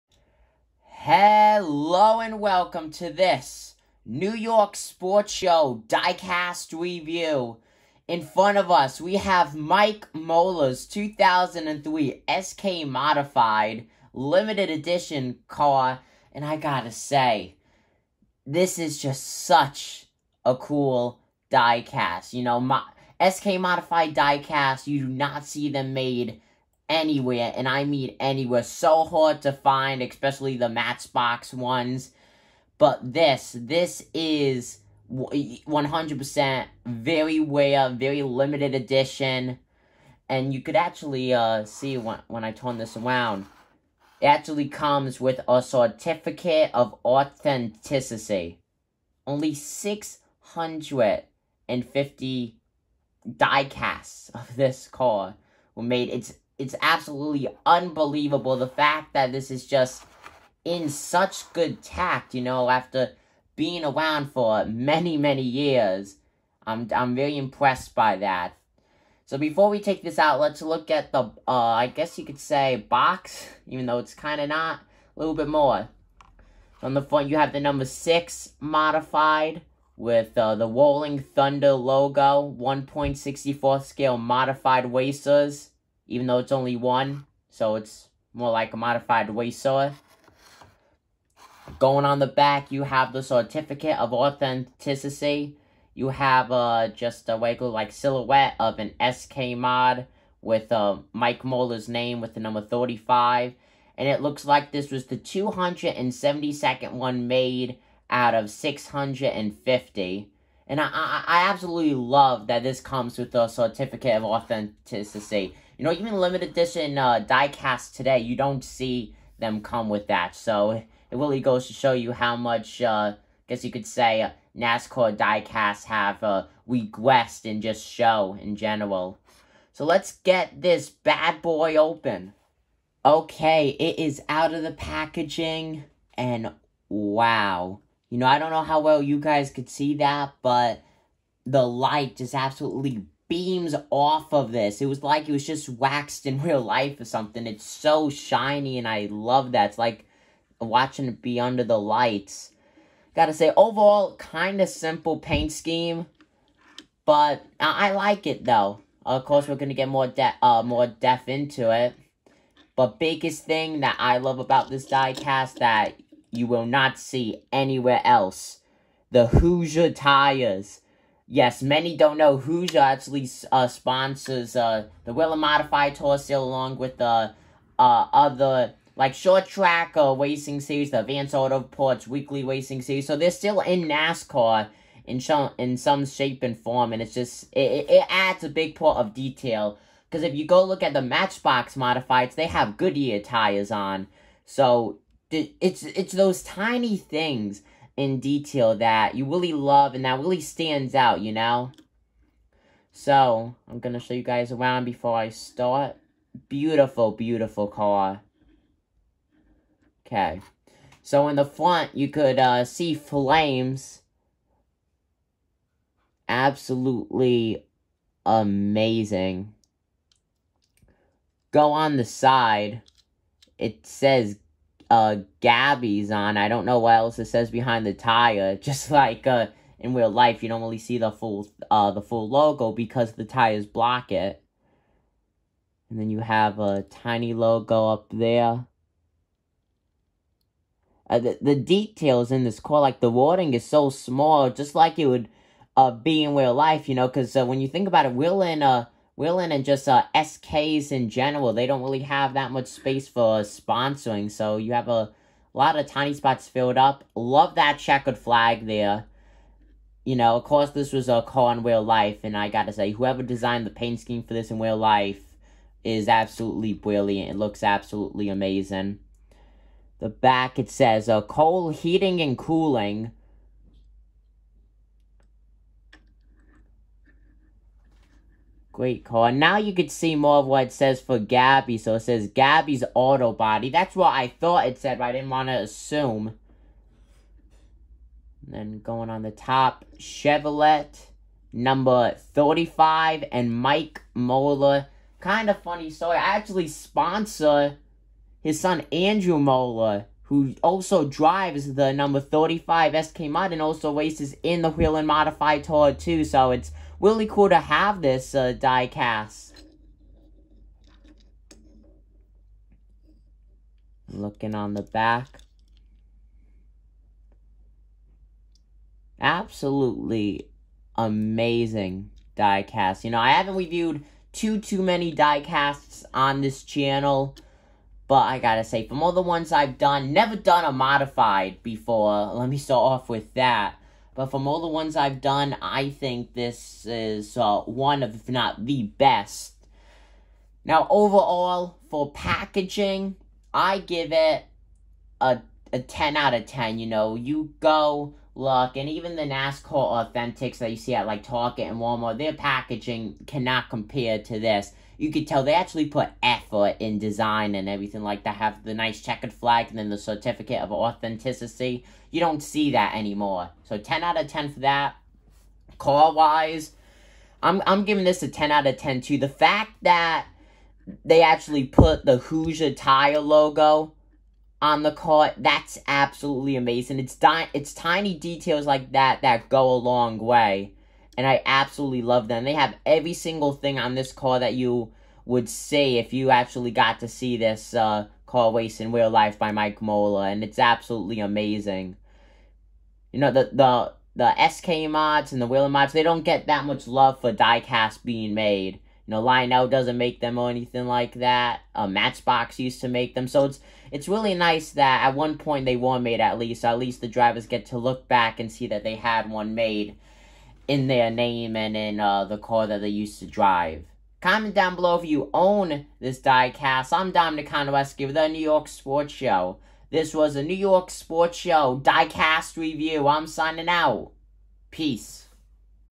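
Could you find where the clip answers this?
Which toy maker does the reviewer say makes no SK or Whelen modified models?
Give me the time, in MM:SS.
06:39.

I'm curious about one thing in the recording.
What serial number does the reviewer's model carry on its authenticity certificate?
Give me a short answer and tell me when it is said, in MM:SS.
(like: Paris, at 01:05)
272nd, at 01:45.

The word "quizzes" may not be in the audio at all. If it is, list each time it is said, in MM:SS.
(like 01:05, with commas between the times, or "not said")
not said.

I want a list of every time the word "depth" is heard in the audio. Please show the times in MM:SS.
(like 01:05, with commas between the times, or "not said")
02:40.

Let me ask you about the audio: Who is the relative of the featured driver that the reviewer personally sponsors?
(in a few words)
Andrew Molleur.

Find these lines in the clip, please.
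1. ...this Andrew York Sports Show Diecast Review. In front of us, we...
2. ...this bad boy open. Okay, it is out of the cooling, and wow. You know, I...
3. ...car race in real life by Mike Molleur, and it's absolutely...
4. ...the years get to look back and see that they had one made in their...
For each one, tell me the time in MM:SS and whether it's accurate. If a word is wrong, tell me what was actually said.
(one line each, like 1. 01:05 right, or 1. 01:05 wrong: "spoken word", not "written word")
1. 00:03 wrong: "New", not "Andrew"
2. 02:10 wrong: "packaging", not "cooling"
3. 06:28 right
4. 06:47 wrong: "drivers", not "years".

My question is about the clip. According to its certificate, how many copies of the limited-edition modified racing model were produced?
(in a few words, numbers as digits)
650.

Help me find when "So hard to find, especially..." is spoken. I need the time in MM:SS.
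00:28.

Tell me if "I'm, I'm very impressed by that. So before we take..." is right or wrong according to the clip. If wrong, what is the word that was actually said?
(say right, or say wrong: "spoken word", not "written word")
right.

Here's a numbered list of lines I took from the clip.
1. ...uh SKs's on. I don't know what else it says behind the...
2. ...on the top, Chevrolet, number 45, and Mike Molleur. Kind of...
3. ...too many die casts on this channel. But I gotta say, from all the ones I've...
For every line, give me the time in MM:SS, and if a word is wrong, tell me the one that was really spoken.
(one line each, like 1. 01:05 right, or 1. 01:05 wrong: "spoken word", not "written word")
1. 03:44 wrong: "Gabby", not "SKs"
2. 04:49 wrong: "35", not "45"
3. 05:24 right.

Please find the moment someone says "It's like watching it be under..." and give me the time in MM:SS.
02:29.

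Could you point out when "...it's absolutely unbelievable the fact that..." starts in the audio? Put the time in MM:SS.
00:56.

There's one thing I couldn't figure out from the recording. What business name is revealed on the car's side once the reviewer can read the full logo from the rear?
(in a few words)
Gabby's Auto Body.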